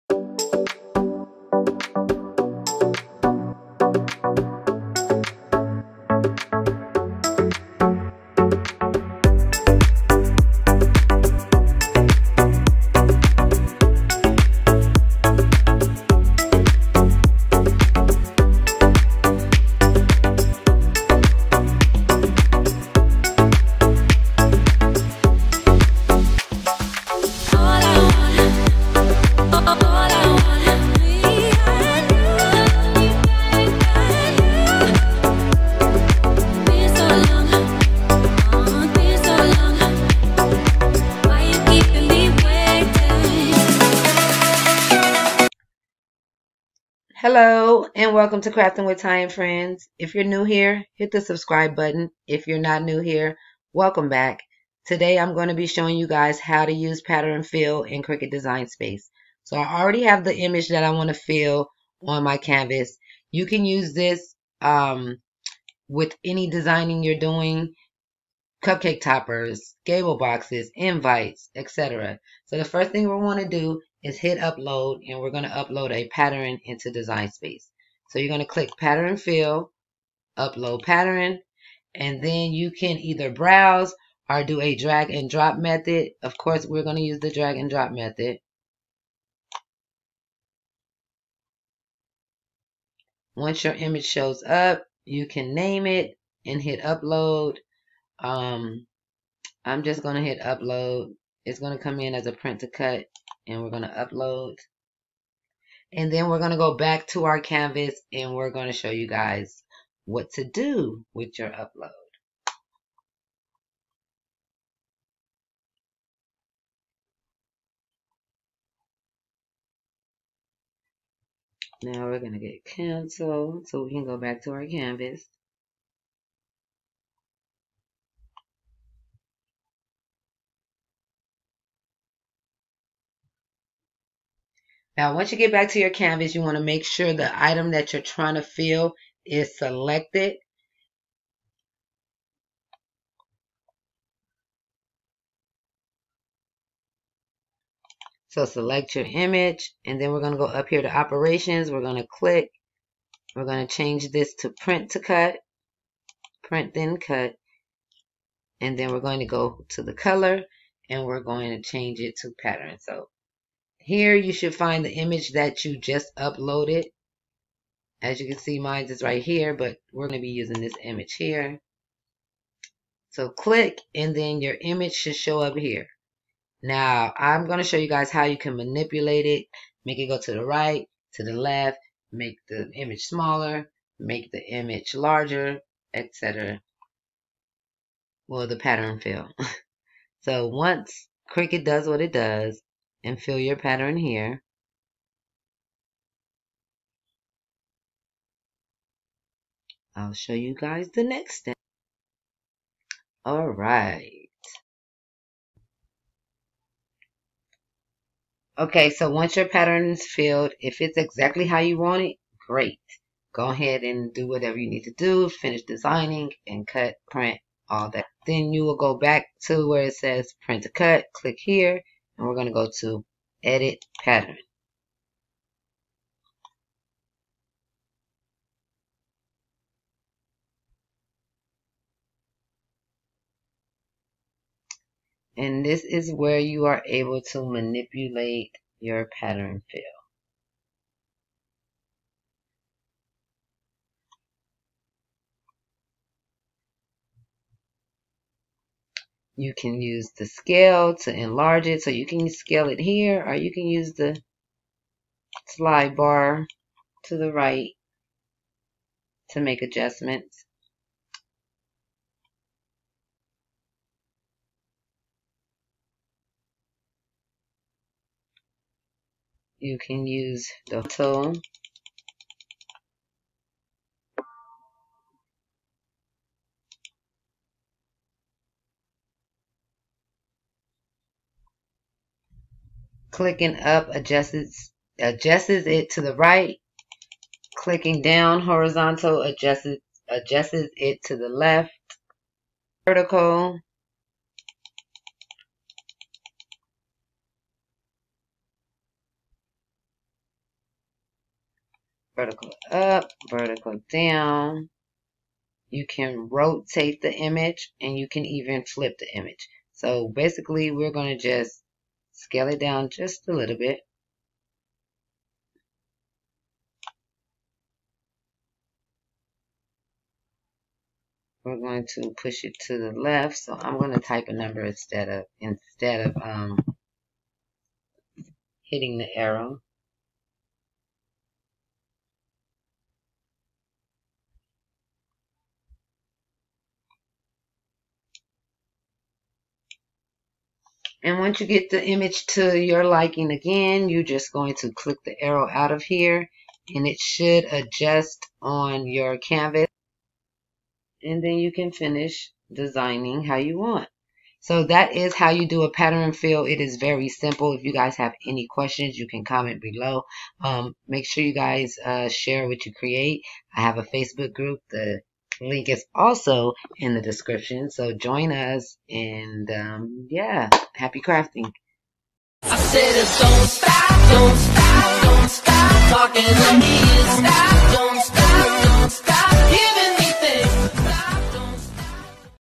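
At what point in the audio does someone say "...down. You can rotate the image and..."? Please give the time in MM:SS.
05:03.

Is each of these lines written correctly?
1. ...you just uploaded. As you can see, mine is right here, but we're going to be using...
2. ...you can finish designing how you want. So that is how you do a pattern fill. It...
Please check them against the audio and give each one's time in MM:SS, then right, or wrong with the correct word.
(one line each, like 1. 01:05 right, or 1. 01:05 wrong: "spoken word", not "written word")
1. 02:45 right
2. 05:51 right.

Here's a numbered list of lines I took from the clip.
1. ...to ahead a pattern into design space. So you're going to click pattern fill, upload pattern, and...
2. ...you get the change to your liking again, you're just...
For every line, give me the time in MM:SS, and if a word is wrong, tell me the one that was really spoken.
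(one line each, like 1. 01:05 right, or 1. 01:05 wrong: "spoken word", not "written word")
1. 01:15 wrong: "upload", not "ahead"
2. 05:41 wrong: "image", not "change".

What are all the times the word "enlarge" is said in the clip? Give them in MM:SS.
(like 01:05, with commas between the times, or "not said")
04:11.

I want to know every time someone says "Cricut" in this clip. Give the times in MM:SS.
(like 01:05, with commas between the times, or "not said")
00:58, 03:11.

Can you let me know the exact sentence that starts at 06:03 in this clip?
I have a Facebook group, the link is also in the description.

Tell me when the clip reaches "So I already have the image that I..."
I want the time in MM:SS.
00:59.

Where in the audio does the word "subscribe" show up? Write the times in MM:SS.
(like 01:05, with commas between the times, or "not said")
00:51.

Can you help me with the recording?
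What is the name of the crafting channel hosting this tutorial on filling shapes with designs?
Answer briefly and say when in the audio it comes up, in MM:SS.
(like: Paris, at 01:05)
Crafting with Ty and friends, at 00:48.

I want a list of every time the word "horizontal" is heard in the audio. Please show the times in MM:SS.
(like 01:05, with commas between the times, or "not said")
04:48.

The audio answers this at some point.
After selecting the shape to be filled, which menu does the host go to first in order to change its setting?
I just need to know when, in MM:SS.
02:30.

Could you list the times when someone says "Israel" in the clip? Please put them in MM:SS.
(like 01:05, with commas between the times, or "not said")
not said.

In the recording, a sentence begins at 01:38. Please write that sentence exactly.
Um, I'm just going to hit upload.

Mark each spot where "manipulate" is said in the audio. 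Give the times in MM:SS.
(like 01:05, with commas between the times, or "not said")
02:58, 03:57.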